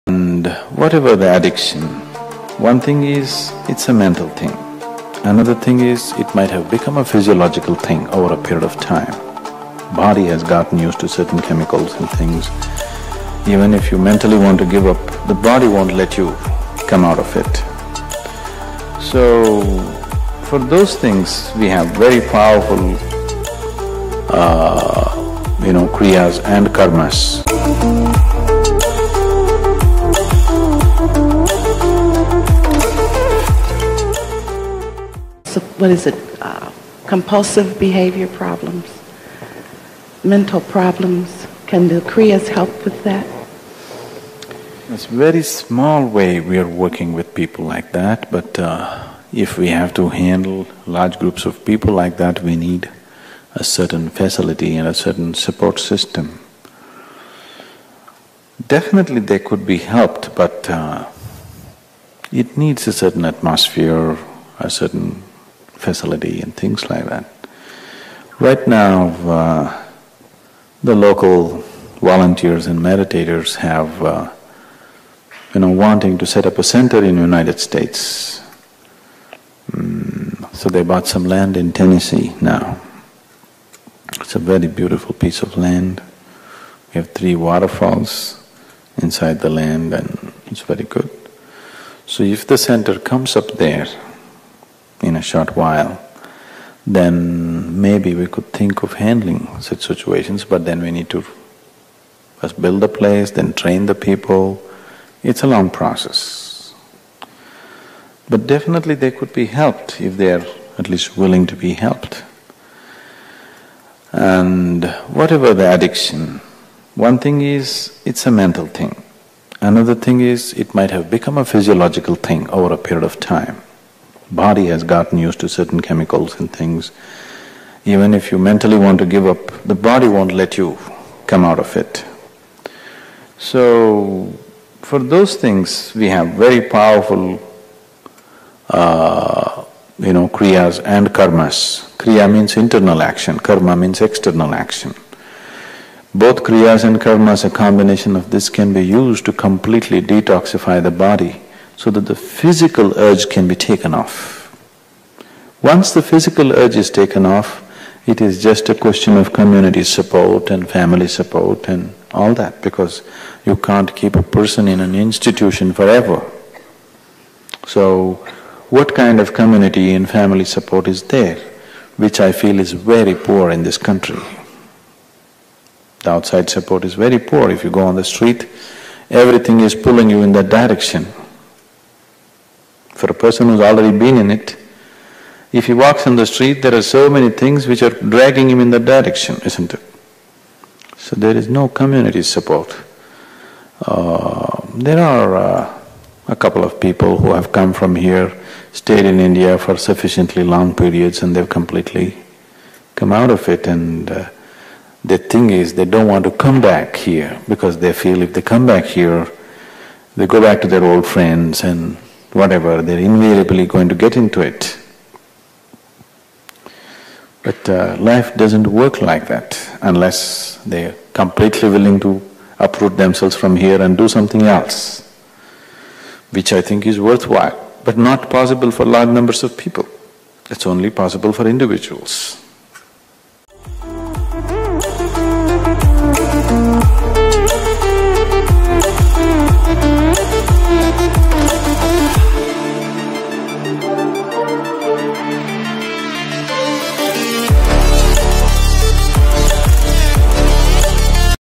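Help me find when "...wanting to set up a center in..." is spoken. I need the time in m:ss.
1:15.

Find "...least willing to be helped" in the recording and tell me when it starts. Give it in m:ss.
1:50.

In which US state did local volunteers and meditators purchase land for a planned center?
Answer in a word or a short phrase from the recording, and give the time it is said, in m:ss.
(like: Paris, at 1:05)
Tennessee, at 1:21.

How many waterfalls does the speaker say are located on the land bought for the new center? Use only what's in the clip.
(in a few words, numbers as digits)
3.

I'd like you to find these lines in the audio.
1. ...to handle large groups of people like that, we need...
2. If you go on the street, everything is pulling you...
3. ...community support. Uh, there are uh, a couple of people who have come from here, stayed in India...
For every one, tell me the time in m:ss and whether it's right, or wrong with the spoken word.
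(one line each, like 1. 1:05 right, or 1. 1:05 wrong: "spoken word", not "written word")
1. 0:49 right
2. 2:57 right
3. 3:11 right.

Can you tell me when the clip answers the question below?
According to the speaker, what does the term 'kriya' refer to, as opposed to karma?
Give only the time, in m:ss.
2:22.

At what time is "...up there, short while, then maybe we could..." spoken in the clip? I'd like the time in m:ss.
1:33.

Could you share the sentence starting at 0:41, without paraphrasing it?
Can the Kriyas help with that?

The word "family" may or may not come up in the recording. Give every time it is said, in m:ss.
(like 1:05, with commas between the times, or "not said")
2:40, 2:50.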